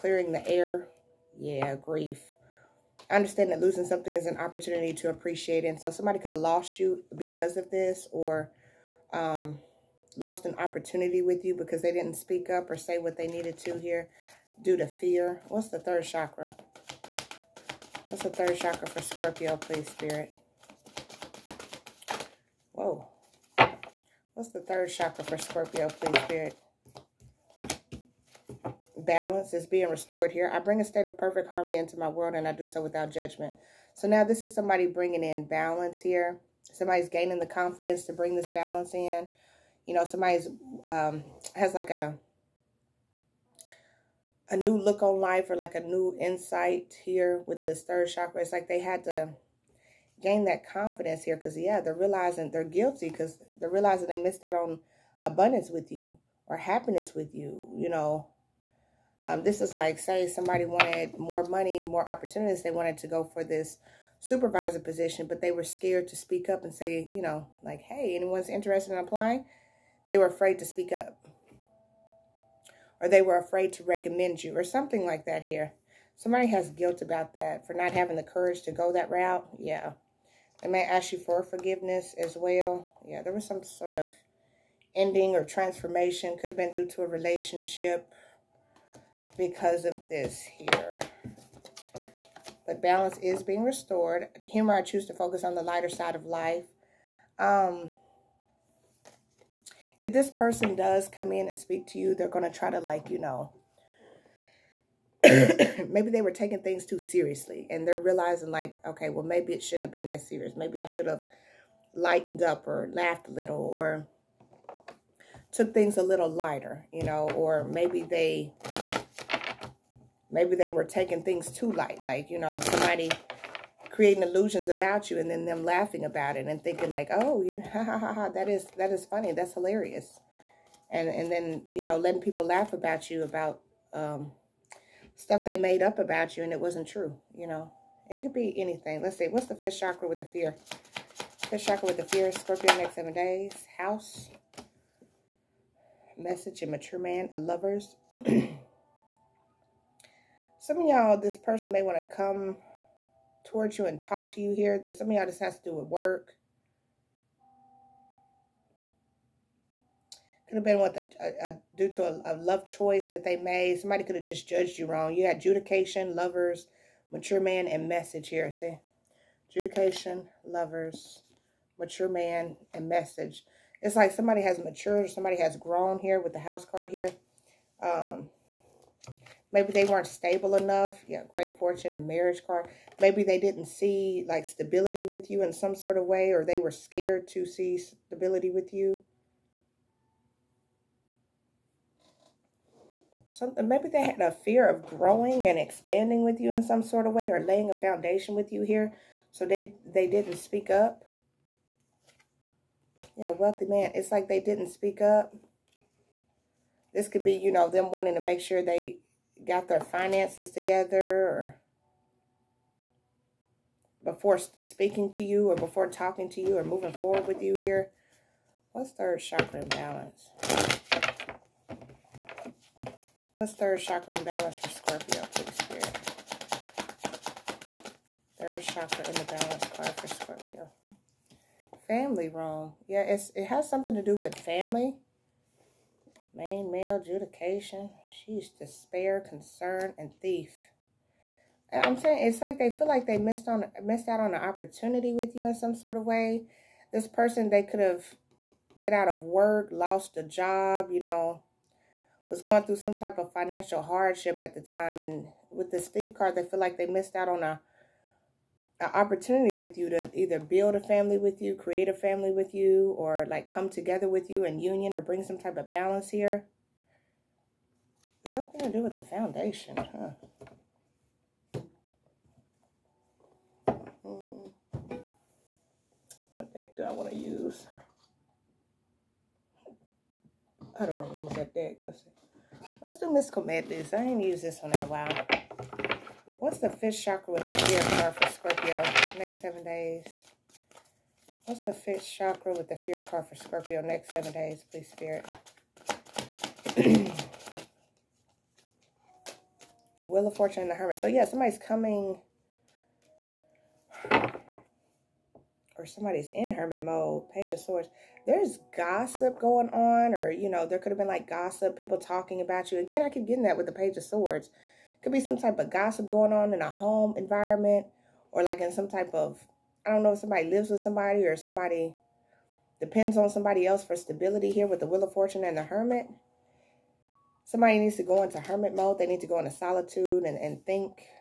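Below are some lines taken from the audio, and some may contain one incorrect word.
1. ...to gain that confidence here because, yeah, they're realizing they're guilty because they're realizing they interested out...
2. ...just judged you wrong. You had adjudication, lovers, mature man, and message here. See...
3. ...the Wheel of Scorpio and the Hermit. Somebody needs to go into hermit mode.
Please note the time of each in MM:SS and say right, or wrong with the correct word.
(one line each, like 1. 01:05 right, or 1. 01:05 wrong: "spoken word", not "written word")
1. 00:49 wrong: "missed", not "interested"
2. 02:44 right
3. 05:24 wrong: "Fortune", not "Scorpio".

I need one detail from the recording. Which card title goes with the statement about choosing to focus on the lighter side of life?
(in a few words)
Humor.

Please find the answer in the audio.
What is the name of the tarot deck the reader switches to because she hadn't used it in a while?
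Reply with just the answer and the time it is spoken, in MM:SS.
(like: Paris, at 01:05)
Mystical Madness, at 04:43.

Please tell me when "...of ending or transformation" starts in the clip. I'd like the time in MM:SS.
01:23.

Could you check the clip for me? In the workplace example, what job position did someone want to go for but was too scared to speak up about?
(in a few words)
Supervisor position.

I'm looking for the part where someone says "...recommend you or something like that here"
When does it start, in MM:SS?
01:13.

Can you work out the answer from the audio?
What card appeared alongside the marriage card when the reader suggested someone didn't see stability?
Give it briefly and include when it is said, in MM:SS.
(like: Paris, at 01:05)
Great fortune, at 03:01.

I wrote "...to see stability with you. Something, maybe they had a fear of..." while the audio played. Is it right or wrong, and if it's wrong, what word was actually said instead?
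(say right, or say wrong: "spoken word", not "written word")
right.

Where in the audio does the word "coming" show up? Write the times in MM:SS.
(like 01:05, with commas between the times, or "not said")
05:01.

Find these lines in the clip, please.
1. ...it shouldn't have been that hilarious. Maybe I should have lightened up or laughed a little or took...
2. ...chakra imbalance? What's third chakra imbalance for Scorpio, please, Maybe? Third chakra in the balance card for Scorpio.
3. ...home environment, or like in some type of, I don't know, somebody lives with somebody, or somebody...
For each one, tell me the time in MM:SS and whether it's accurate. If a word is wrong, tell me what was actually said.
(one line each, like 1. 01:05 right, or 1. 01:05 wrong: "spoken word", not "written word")
1. 01:49 wrong: "serious", not "hilarious"
2. 03:39 wrong: "Spirit", not "Maybe"
3. 05:16 right.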